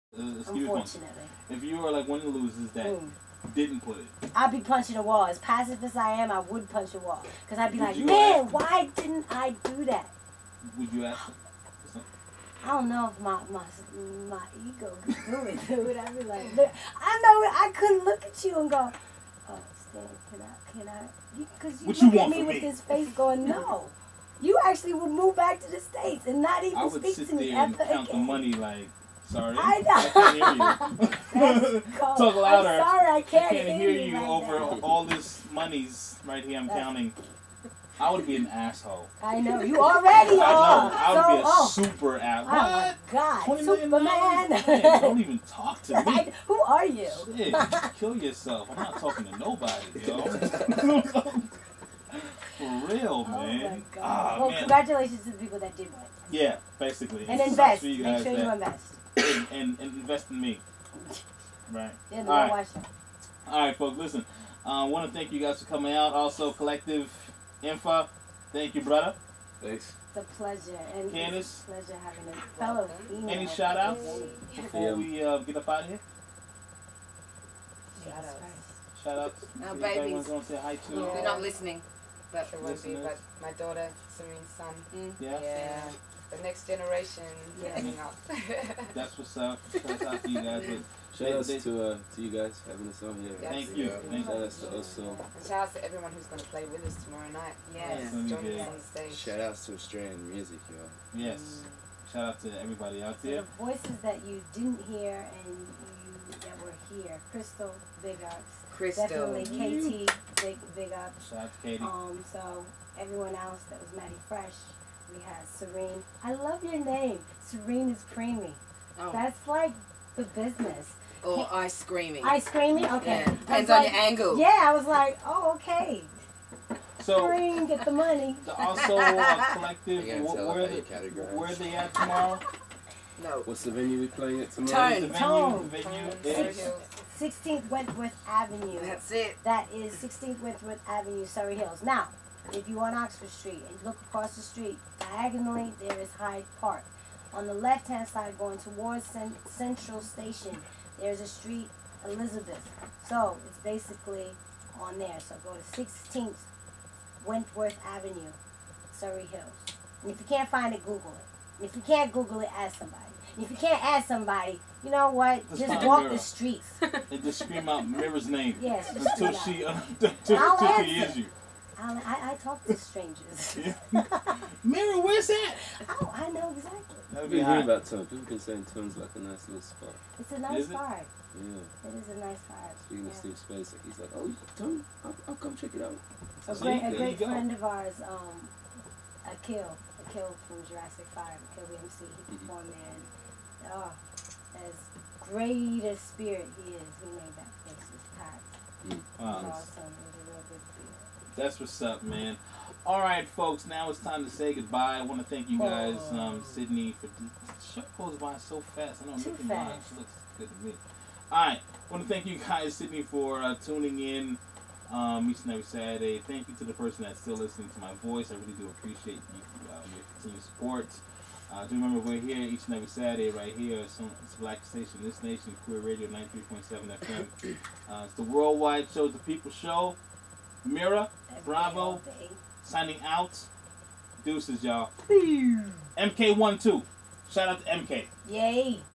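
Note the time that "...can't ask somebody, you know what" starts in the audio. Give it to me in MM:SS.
02:43.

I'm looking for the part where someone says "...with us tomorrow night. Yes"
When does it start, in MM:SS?
01:36.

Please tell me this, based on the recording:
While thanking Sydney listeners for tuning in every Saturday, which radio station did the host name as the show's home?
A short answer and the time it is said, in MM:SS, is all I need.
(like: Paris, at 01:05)
Koori Radio, at 03:45.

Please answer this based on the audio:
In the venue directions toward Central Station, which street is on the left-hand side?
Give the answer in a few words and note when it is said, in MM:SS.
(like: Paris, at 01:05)
Elizabeth, at 02:32.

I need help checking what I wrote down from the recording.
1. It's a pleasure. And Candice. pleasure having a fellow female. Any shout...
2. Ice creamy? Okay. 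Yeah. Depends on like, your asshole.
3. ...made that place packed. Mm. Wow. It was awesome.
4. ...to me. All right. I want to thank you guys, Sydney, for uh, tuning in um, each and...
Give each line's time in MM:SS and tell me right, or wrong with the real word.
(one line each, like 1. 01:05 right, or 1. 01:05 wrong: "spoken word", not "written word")
1. 01:10 right
2. 02:02 wrong: "angle", not "asshole"
3. 03:17 right
4. 03:30 right.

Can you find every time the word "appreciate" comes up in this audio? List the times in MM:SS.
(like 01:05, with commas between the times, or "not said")
03:38.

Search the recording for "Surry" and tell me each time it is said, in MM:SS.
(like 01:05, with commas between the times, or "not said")
02:21, 02:38.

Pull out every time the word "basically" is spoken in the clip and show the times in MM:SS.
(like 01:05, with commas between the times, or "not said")
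00:56, 02:33.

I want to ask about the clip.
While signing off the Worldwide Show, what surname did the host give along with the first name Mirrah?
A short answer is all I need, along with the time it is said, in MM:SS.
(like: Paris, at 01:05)
Bravo, at 03:51.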